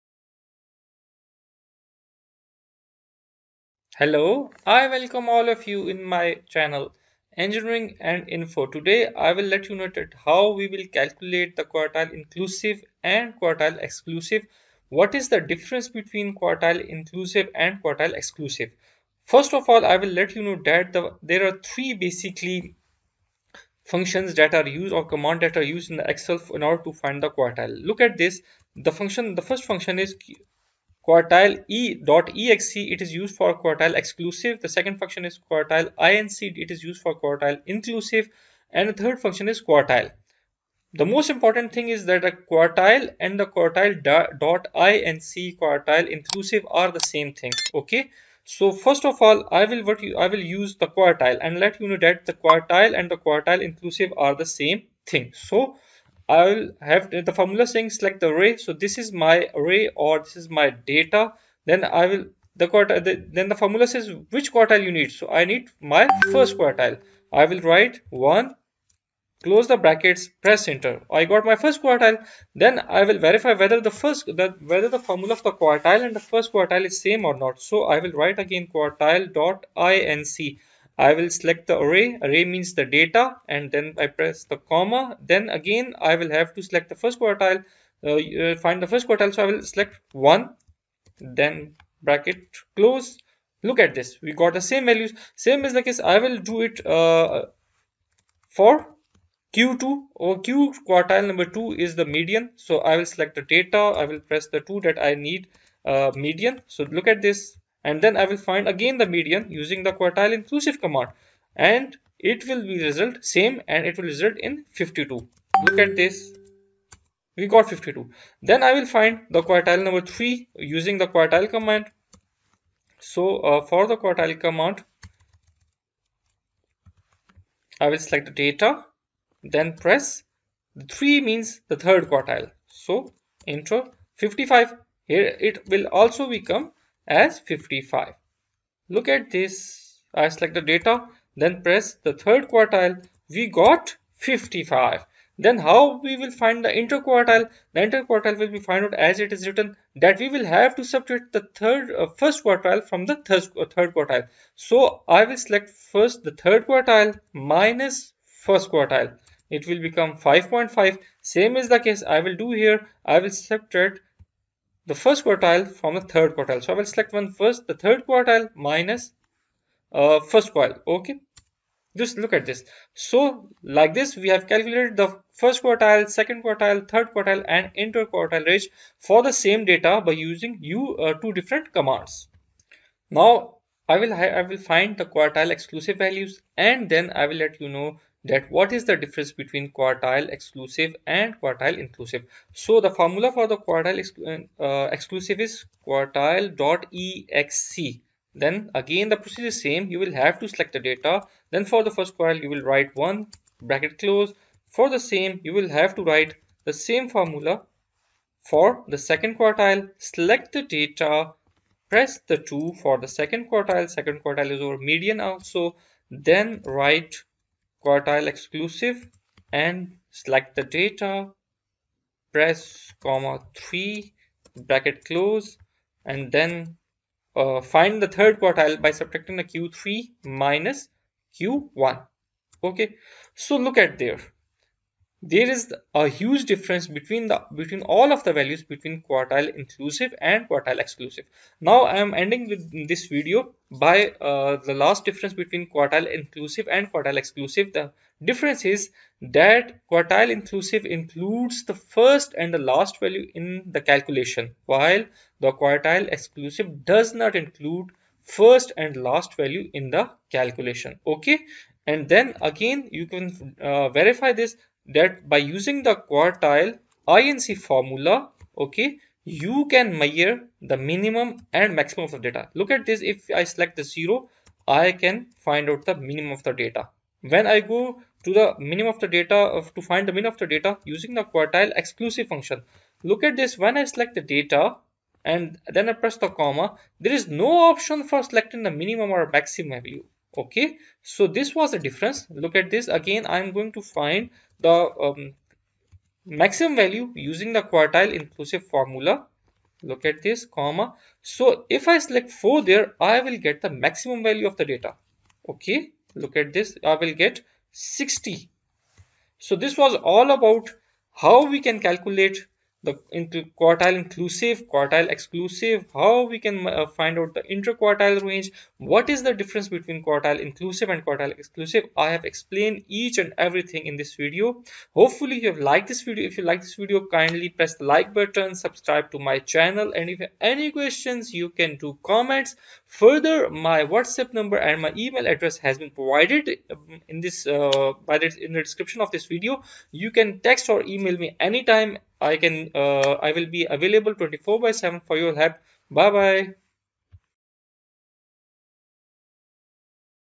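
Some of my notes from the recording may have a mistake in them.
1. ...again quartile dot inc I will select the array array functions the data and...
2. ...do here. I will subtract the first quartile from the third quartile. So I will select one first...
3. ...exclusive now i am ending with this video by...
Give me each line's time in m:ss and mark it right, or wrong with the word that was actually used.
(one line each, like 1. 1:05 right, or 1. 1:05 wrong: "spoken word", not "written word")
1. 1:18 wrong: "means", not "functions"
2. 2:42 right
3. 4:00 right.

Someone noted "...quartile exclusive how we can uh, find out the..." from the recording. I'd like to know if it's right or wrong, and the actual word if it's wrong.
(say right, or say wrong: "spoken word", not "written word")
right.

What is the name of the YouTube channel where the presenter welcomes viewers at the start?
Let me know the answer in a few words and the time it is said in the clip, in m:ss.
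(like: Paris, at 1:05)
Engineering and Info, at 0:07.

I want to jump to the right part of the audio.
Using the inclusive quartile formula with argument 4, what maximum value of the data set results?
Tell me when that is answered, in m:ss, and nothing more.
5:07.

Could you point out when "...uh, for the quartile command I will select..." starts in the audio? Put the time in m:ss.
2:03.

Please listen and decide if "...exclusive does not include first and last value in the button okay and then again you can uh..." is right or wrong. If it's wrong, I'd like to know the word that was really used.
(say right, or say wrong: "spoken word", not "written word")
wrong: "calculation", not "button".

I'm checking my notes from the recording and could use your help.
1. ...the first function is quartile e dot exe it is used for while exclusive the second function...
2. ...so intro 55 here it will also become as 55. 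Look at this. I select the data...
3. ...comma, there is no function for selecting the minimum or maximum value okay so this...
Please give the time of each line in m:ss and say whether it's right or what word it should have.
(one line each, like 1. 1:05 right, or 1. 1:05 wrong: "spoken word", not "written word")
1. 0:29 wrong: "quartile", not "while"
2. 2:12 right
3. 4:46 wrong: "option", not "function".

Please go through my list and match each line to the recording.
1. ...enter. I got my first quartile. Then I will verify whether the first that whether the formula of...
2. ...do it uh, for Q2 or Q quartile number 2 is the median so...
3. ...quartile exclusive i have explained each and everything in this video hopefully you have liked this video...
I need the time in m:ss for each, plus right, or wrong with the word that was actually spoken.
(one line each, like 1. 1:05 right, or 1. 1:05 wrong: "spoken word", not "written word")
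1. 1:10 right
2. 1:36 right
3. 5:21 right.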